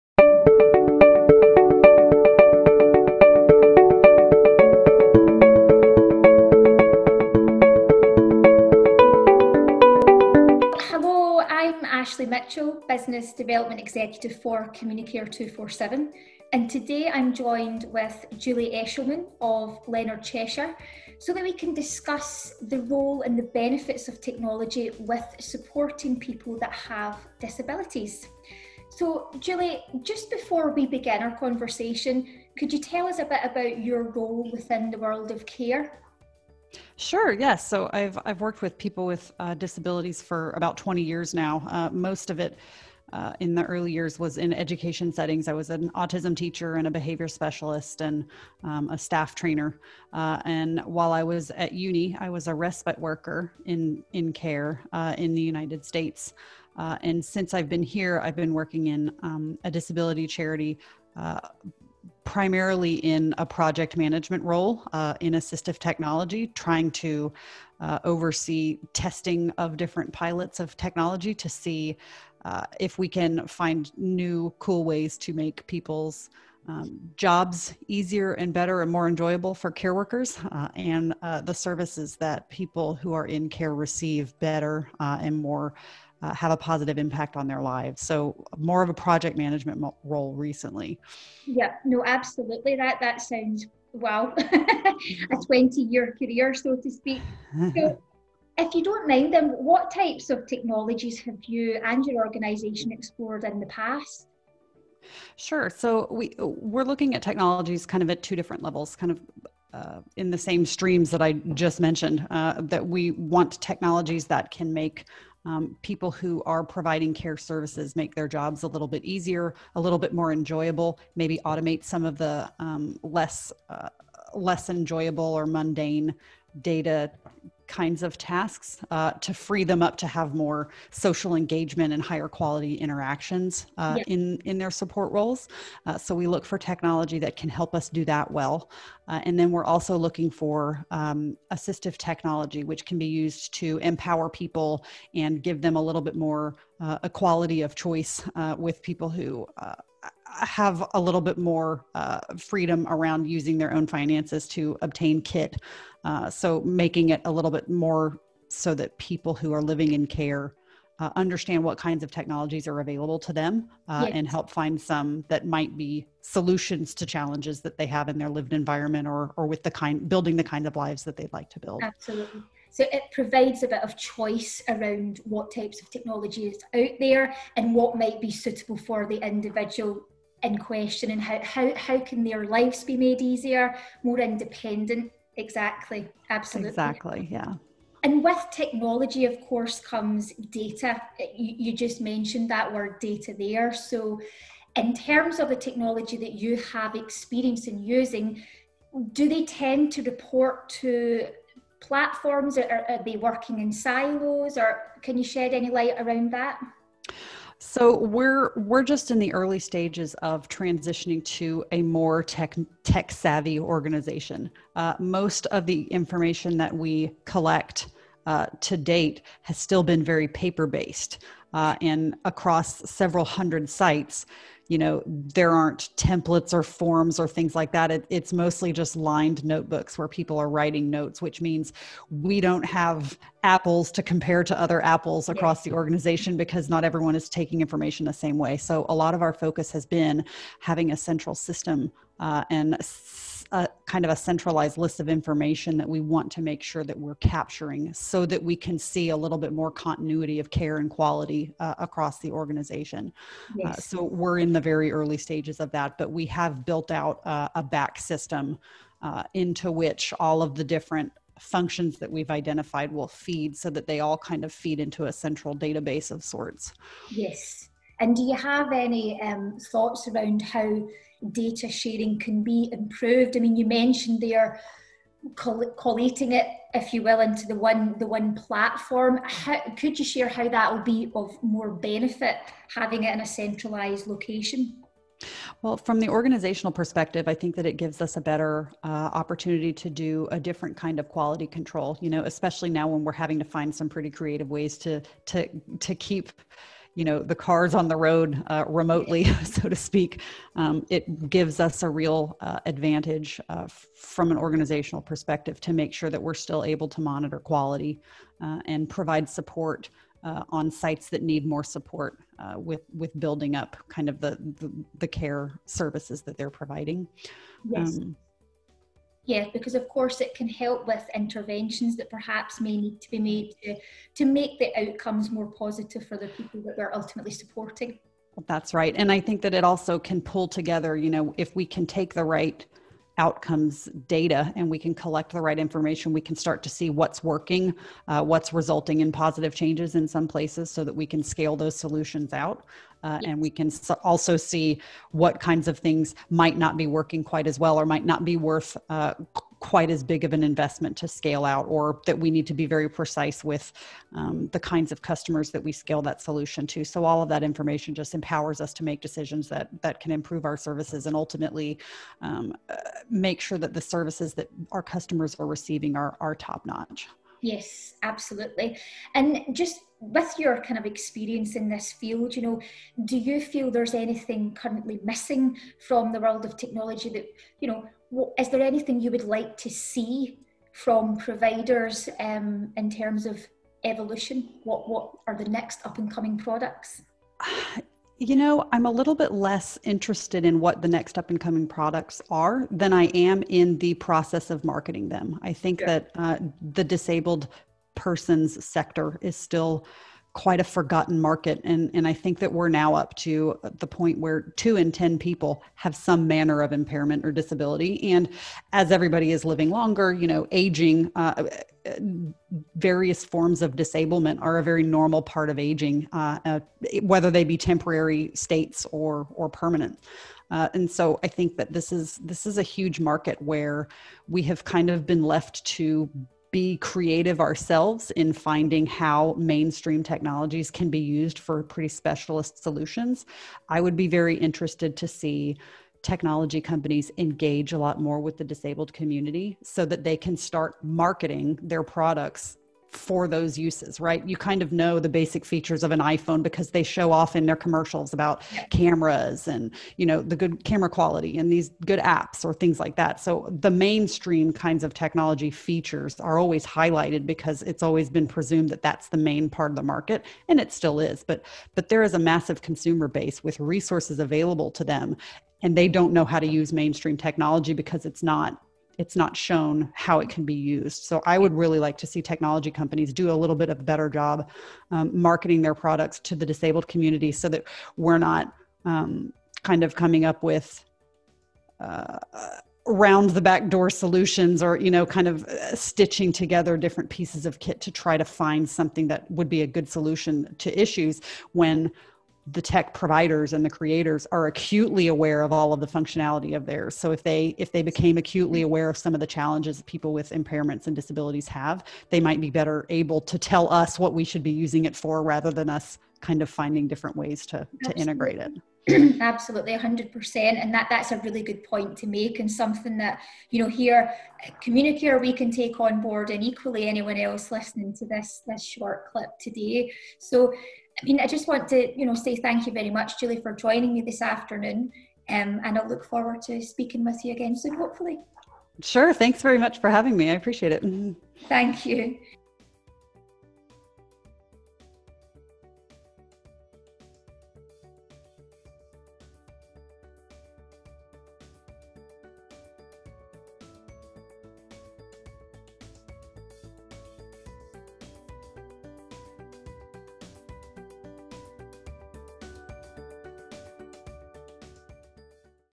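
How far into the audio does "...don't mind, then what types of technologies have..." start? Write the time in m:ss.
1:38.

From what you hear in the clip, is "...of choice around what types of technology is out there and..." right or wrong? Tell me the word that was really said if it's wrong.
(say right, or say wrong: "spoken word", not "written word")
right.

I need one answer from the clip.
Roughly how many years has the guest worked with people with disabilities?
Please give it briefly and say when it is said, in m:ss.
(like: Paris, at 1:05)
20 years, at 0:40.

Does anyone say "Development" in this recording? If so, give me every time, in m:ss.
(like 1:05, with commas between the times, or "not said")
0:13.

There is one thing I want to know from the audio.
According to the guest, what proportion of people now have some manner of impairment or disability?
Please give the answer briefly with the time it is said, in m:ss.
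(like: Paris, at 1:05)
2 in 10, at 6:44.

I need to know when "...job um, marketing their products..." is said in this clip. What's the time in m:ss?
7:54.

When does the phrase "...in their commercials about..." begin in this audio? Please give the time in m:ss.
7:27.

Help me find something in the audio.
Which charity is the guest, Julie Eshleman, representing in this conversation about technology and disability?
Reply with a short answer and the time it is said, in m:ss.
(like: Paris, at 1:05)
Leonard Cheshire, at 0:19.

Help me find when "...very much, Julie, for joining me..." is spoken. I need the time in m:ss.
8:42.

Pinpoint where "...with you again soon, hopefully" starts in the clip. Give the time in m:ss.
8:47.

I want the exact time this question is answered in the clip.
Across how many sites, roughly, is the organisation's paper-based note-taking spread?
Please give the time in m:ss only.
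3:42.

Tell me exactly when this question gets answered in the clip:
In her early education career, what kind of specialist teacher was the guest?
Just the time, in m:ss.
0:45.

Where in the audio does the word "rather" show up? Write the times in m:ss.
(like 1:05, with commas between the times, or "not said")
8:25.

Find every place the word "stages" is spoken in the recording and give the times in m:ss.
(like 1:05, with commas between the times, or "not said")
3:29, 4:15.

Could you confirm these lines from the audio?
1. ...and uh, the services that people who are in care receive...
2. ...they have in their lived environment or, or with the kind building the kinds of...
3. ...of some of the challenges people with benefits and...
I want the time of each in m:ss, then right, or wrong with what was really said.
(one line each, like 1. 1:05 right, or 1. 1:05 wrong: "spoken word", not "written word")
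1. 1:20 right
2. 2:47 right
3. 8:18 wrong: "impairments", not "benefits".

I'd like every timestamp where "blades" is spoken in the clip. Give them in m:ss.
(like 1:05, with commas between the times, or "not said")
not said.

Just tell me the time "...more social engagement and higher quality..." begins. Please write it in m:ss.
2:10.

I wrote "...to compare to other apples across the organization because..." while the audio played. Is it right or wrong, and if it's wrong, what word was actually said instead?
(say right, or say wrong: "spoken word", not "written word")
right.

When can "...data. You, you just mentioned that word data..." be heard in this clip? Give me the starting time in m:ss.
3:10.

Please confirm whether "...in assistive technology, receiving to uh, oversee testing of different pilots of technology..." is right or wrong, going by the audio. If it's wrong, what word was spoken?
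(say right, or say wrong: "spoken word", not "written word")
wrong: "trying", not "receiving".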